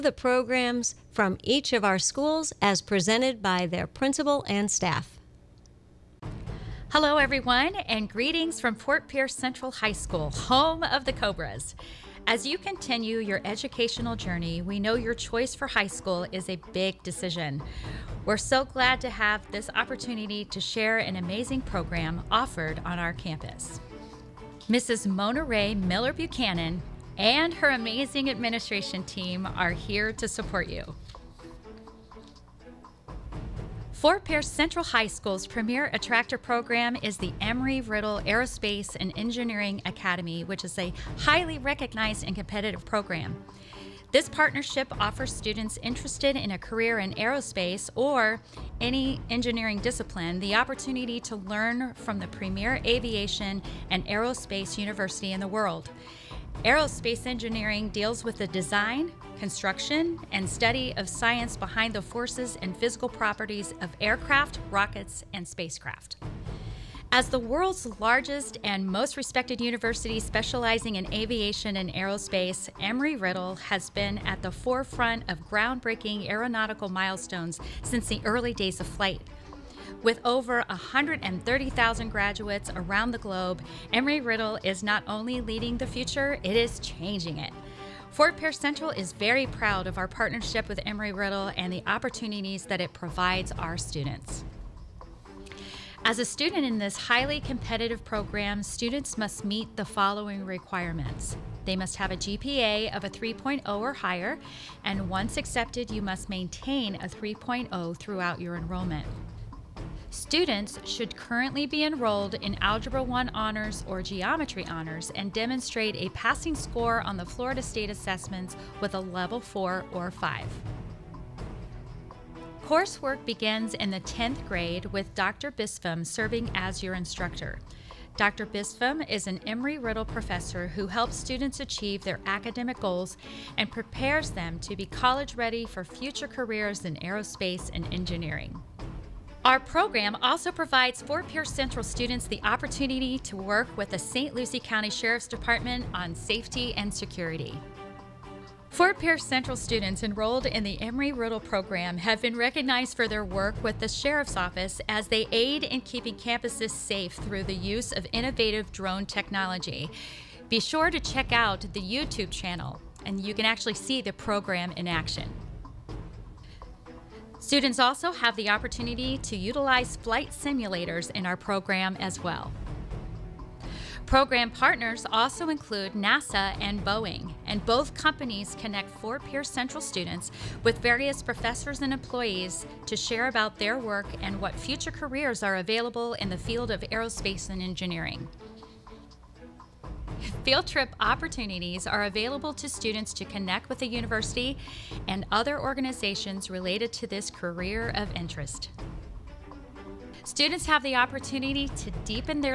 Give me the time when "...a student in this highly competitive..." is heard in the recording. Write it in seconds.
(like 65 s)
96 s.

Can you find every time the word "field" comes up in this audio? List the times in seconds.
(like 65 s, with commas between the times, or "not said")
186 s, 190 s.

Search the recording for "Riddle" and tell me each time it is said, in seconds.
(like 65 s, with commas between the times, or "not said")
37 s, 72 s, 84 s, 91 s, 129 s, 151 s.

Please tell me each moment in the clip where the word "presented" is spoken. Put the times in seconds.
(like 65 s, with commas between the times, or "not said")
2 s.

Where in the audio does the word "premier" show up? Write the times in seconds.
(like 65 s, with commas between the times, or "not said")
35 s, 52 s.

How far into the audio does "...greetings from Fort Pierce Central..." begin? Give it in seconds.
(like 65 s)
8 s.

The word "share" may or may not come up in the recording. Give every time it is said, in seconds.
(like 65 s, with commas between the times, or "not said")
20 s, 182 s.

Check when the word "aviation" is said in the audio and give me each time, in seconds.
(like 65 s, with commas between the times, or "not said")
52 s, 71 s.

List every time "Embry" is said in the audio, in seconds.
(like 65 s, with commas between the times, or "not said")
37 s, 72 s, 83 s, 90 s, 129 s, 150 s.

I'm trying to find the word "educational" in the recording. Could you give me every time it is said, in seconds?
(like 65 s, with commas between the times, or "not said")
13 s.